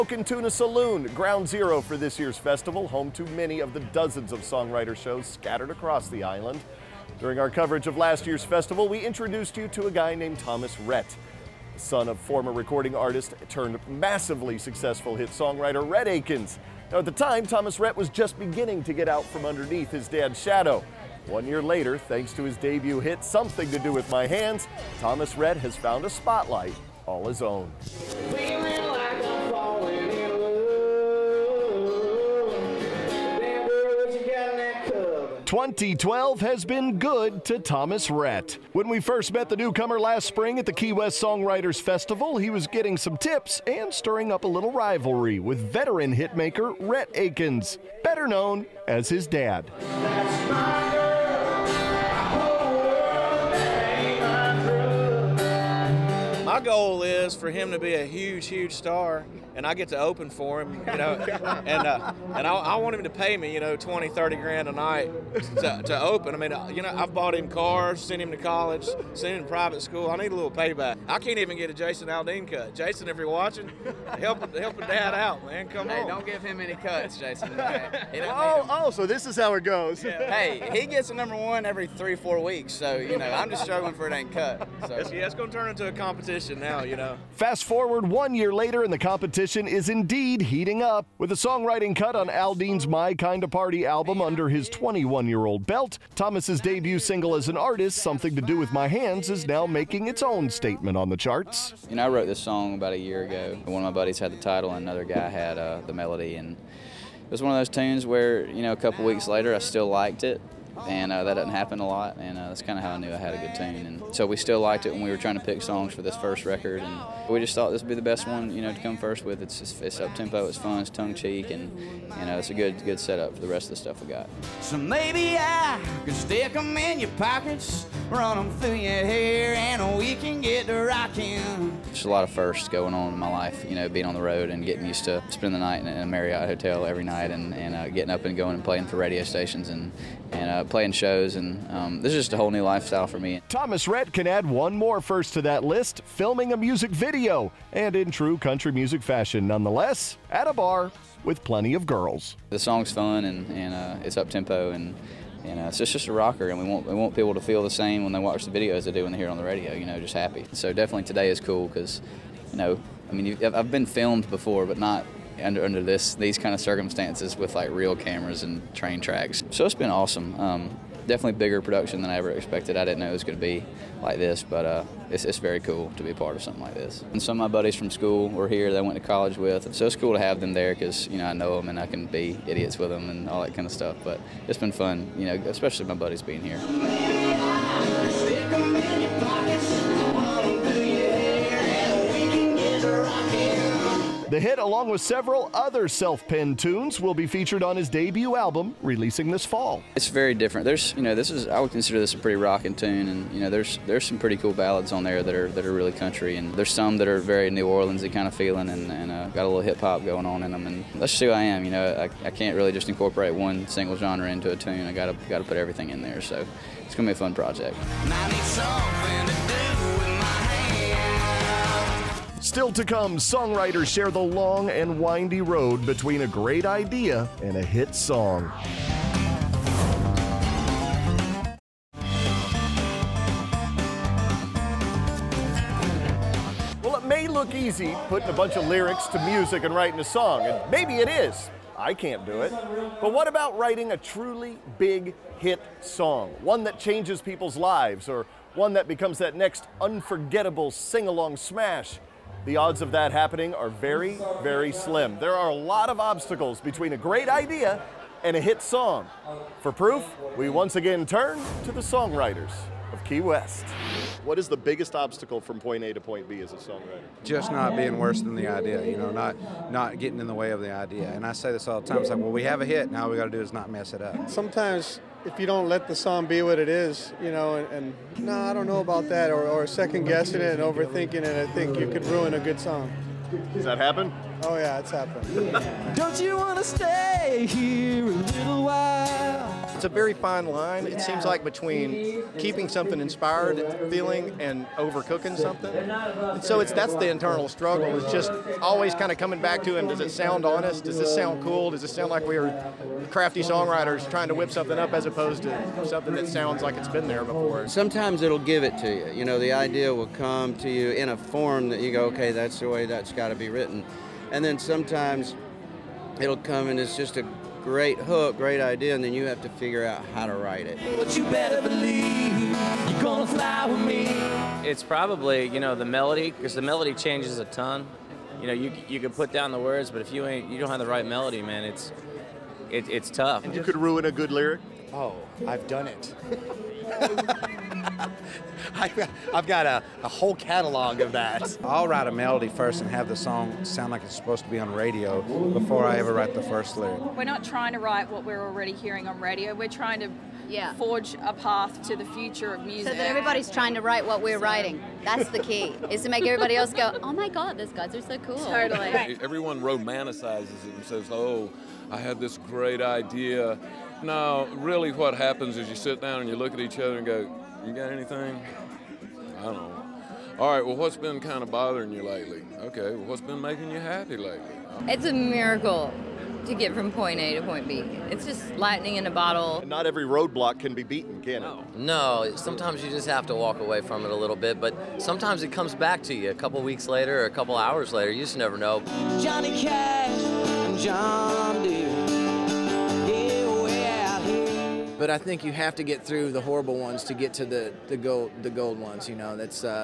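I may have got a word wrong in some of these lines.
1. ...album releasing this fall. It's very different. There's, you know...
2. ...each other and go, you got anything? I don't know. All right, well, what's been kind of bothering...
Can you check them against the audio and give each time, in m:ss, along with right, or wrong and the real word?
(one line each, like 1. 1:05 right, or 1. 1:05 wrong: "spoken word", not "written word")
1. 3:18 right
2. 6:06 right.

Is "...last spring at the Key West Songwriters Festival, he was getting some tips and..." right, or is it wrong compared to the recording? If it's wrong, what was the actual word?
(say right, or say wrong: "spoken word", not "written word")
right.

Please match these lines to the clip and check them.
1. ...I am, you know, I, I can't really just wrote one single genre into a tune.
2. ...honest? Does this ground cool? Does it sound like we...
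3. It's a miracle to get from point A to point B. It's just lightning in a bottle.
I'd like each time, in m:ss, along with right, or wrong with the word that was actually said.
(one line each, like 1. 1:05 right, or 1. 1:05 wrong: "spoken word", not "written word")
1. 3:31 wrong: "incorporate", not "wrote"
2. 5:00 wrong: "sound", not "ground"
3. 6:14 right.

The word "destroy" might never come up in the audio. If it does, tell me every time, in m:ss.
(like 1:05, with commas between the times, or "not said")
not said.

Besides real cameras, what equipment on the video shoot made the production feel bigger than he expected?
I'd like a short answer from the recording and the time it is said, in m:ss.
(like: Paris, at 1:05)
Train tracks, at 2:48.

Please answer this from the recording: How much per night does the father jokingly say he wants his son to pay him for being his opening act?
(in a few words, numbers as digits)
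20, 30 grand.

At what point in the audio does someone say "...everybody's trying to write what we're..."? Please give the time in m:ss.
5:53.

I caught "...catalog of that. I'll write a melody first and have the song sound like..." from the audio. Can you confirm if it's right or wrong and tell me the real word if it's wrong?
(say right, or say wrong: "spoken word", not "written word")
right.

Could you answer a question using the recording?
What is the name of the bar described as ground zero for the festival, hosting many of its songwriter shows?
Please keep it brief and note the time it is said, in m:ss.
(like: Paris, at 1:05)
Tuna Saloon, at 0:00.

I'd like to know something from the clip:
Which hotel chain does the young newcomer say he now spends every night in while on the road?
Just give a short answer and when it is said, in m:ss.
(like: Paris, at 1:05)
Marriott, at 2:16.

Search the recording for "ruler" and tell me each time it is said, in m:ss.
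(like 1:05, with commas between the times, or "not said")
not said.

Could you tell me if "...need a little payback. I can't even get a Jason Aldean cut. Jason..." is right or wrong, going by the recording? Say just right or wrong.
right.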